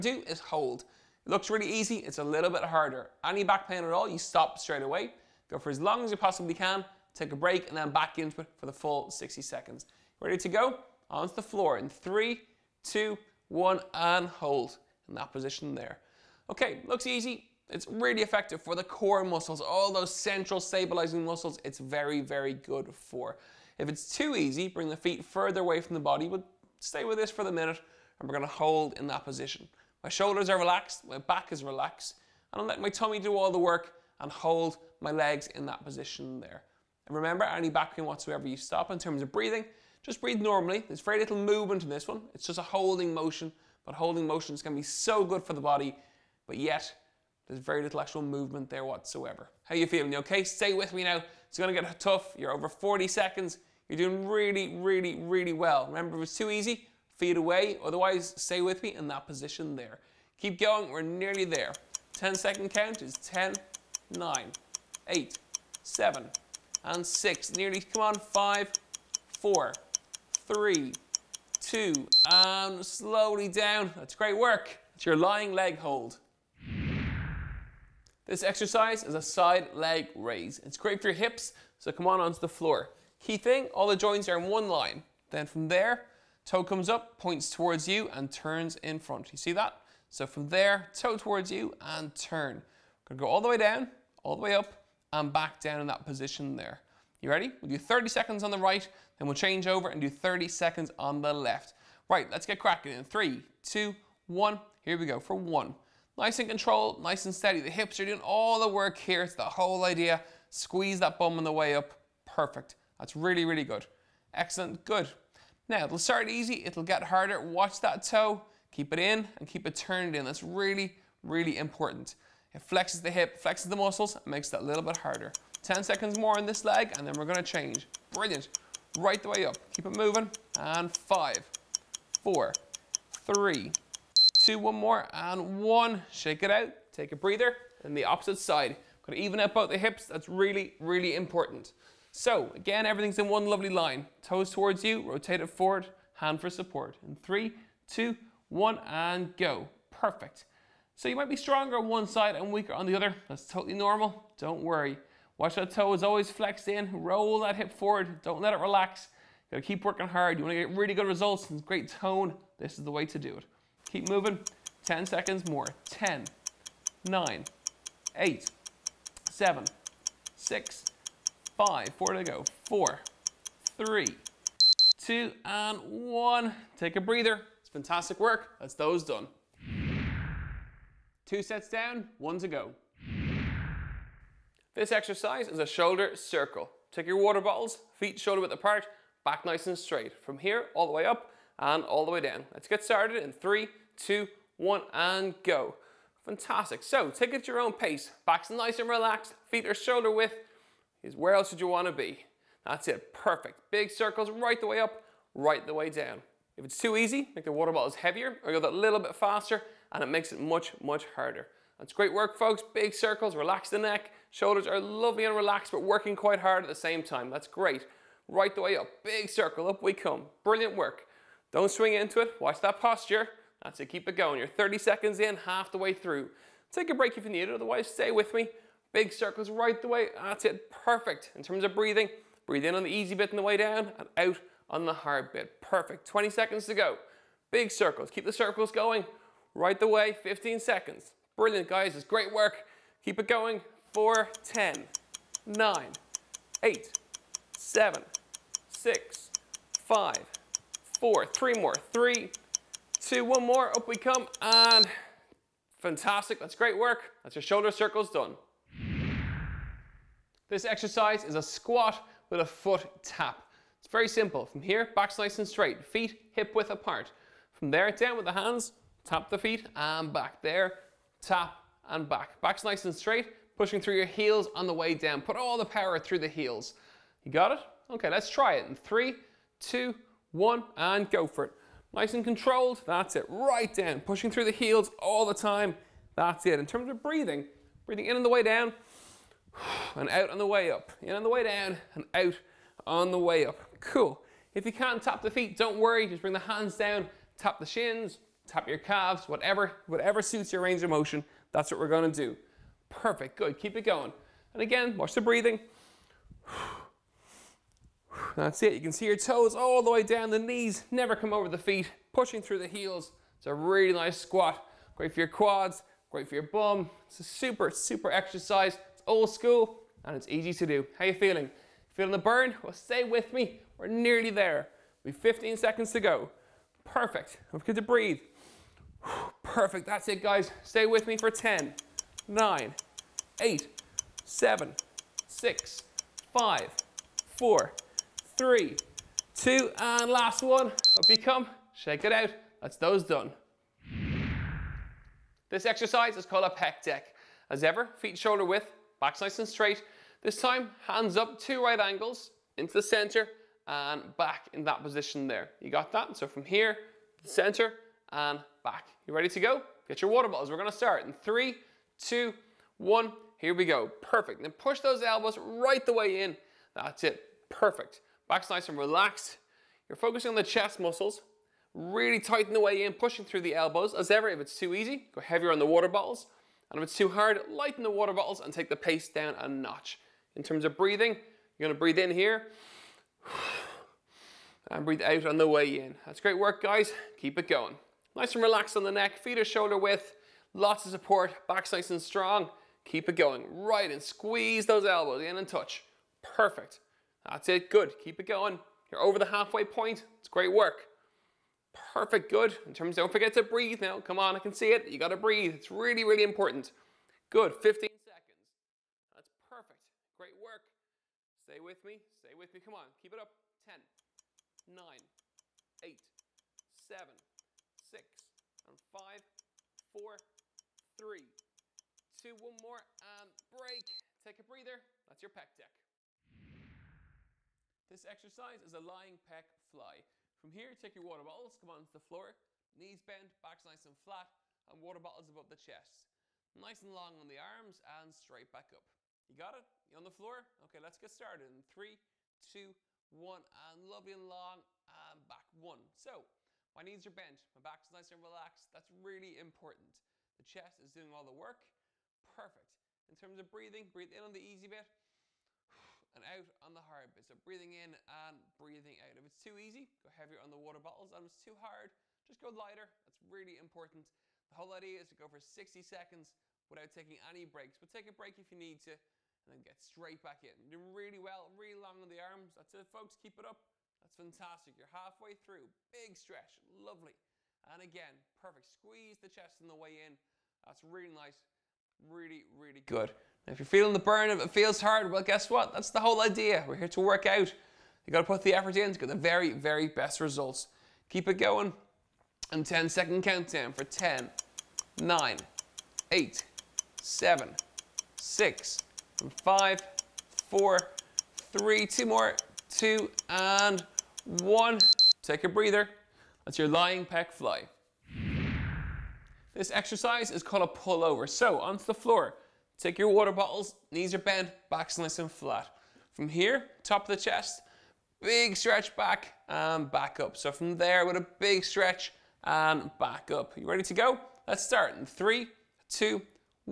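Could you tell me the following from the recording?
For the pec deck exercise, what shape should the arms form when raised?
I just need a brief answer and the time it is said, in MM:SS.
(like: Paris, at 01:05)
Two right angles, at 05:51.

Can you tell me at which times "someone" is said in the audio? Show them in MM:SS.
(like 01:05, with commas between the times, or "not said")
not said.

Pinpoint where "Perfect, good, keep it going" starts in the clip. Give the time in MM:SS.
05:02.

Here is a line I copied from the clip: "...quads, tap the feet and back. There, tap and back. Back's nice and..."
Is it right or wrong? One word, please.
wrong.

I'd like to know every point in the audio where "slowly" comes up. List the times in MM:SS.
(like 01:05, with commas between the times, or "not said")
01:12.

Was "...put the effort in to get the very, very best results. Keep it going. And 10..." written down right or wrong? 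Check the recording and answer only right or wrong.
right.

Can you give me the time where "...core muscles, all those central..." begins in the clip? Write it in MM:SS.
00:18.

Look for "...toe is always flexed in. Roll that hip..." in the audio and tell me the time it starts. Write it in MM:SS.
02:35.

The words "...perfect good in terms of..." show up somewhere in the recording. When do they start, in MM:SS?
06:41.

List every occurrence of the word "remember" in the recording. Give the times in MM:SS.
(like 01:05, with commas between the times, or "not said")
00:37, 00:55.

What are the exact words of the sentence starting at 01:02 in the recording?
10 second count is 10, 9, 8, 7, and 6.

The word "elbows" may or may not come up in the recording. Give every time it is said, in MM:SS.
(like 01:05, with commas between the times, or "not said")
06:05, 06:13, 06:34.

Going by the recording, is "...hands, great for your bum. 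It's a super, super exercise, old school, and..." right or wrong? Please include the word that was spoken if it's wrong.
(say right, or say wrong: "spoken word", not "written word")
wrong: "quads", not "hands".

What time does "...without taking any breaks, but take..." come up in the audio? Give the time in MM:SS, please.
07:46.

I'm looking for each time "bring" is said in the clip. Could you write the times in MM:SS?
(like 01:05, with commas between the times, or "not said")
00:24, 04:56.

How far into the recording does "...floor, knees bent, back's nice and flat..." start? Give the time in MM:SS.
07:11.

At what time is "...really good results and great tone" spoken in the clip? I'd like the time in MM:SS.
02:40.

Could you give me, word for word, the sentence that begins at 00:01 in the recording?
It looks really easy, it's a little bit harder.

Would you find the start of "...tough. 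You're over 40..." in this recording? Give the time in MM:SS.
00:51.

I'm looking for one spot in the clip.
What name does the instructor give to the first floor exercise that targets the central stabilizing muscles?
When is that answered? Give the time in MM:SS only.
01:15.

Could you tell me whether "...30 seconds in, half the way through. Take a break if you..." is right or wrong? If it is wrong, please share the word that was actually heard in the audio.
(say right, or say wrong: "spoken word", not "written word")
right.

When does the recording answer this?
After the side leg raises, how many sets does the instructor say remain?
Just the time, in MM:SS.
03:02.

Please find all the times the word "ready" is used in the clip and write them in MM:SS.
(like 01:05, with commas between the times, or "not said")
00:10, 01:37, 05:59, 08:43.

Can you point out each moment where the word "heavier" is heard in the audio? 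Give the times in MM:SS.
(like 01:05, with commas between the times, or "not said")
03:27, 06:15, 07:40.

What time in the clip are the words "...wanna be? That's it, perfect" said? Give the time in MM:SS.
03:21.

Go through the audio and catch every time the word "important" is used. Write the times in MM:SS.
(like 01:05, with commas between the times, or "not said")
02:01, 02:21, 06:46, 07:29, 07:43.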